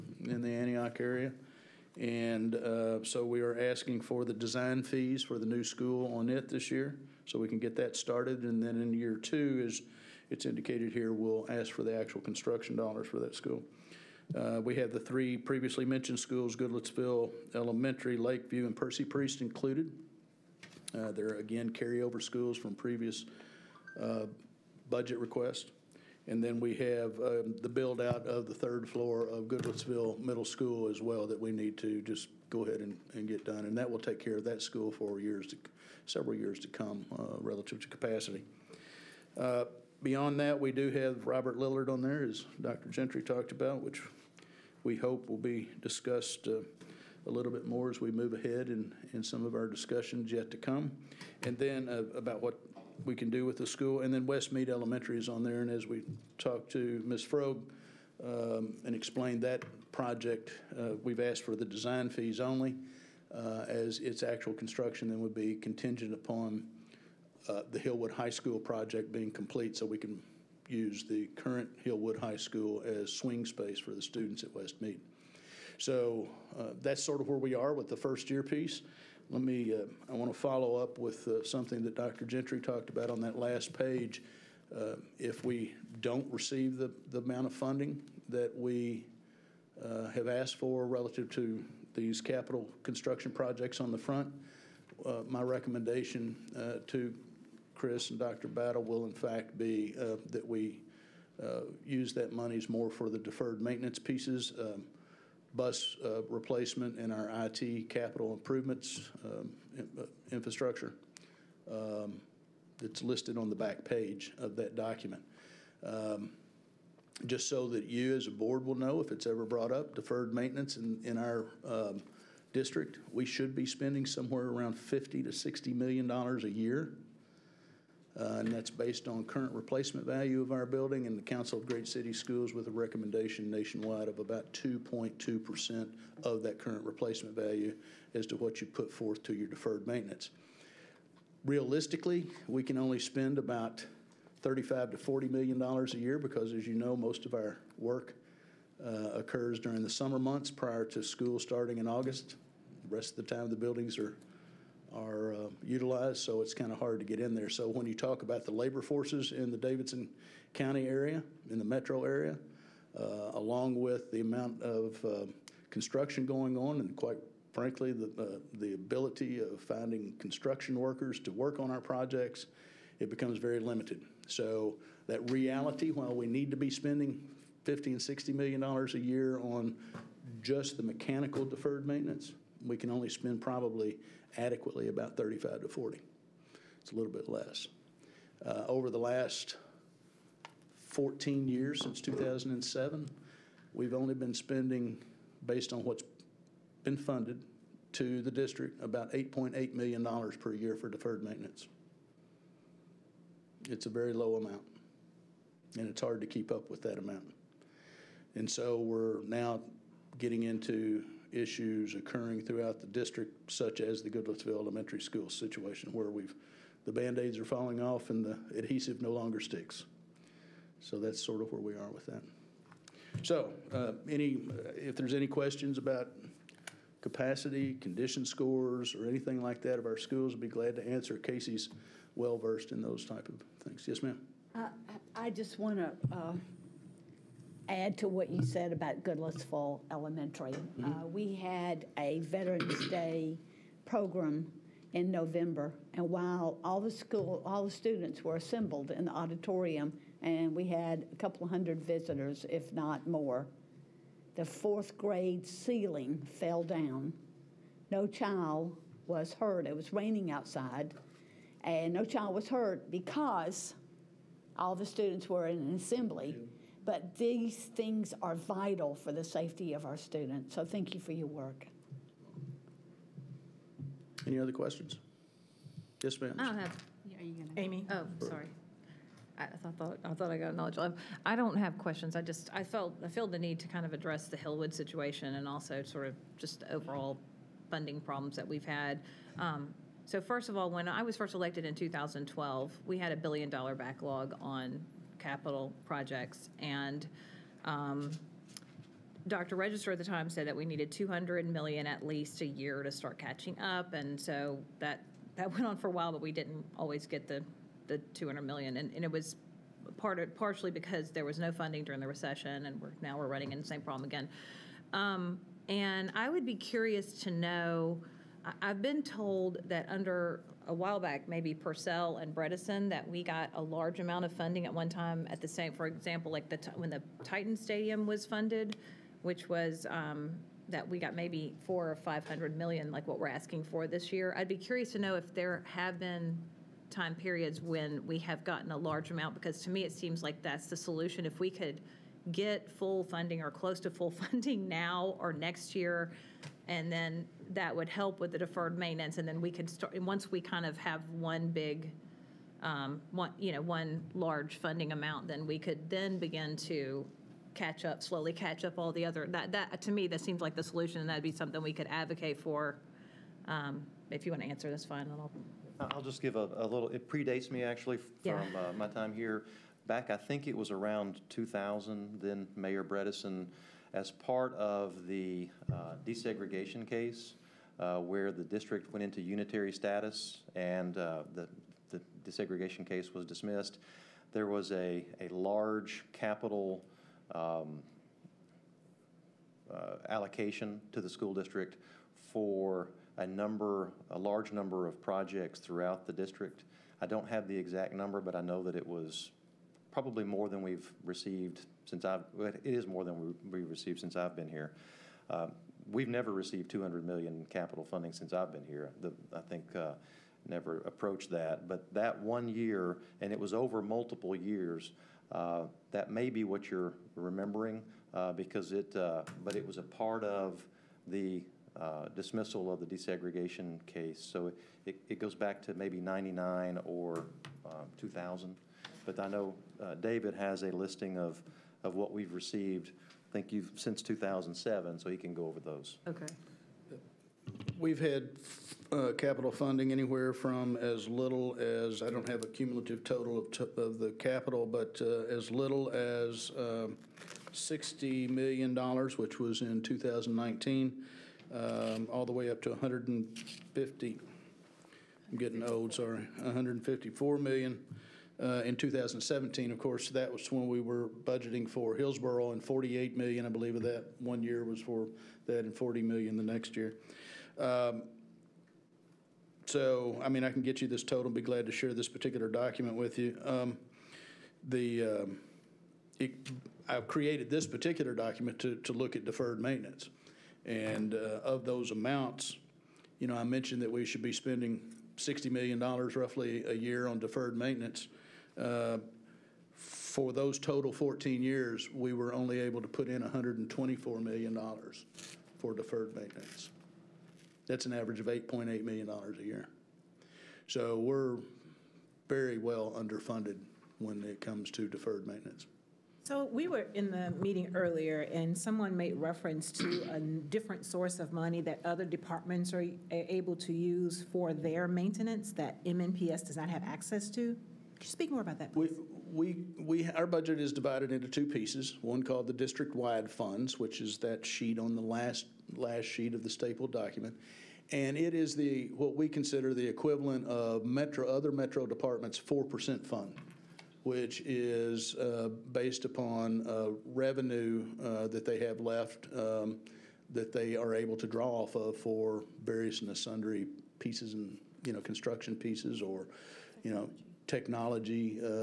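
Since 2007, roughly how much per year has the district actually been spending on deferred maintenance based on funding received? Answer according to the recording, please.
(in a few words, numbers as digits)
$8.8 million.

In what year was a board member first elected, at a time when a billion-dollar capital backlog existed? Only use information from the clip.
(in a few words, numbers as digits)
2012.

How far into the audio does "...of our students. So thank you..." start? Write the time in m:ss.
4:29.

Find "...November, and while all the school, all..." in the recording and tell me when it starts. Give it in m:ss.
4:05.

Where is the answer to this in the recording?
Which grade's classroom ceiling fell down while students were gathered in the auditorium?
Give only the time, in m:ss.
4:14.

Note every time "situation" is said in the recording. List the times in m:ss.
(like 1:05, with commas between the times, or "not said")
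3:35, 4:44.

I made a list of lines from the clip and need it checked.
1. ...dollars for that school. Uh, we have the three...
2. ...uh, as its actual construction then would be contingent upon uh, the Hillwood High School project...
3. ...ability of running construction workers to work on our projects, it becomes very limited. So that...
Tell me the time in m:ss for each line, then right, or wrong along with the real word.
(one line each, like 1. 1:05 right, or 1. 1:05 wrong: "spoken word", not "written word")
1. 0:12 right
2. 1:03 right
3. 2:48 wrong: "finding", not "running".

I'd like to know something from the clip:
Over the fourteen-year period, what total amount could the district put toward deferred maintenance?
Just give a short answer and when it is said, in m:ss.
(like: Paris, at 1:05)
$124 million, at 8:13.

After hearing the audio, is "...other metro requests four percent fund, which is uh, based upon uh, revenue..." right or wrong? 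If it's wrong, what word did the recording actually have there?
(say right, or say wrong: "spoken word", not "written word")
wrong: "departments", not "requests".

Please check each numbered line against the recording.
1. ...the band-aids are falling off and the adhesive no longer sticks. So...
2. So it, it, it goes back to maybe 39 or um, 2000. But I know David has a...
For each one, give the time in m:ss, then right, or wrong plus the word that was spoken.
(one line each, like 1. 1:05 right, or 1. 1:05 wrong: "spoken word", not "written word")
1. 3:36 right
2. 7:04 wrong: "99", not "39".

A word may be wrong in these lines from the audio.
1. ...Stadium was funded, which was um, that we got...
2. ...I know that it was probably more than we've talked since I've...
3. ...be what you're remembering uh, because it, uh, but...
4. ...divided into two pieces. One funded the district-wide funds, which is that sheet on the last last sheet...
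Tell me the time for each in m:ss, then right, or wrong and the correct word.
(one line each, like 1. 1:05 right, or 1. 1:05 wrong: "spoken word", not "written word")
1. 5:27 right
2. 6:38 wrong: "received", not "talked"
3. 6:56 right
4. 8:40 wrong: "called", not "funded".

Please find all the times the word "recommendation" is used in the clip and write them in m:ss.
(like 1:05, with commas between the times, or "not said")
1:35, 2:12.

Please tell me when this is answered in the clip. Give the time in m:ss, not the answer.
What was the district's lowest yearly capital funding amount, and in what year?
7:27.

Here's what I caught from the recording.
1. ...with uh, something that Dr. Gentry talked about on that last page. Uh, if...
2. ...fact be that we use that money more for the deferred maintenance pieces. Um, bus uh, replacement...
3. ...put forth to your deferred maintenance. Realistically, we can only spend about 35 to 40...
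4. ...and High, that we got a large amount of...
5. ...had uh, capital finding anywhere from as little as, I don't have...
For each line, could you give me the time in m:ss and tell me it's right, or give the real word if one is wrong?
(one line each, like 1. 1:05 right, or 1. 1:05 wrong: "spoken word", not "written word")
1. 1:20 right
2. 1:39 right
3. 2:18 right
4. 5:22 wrong: "Bredesen", not "High"
5. 7:17 wrong: "funding", not "finding".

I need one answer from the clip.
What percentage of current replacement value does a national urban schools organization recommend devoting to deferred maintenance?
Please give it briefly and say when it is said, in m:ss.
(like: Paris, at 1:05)
2.2%, at 2:14.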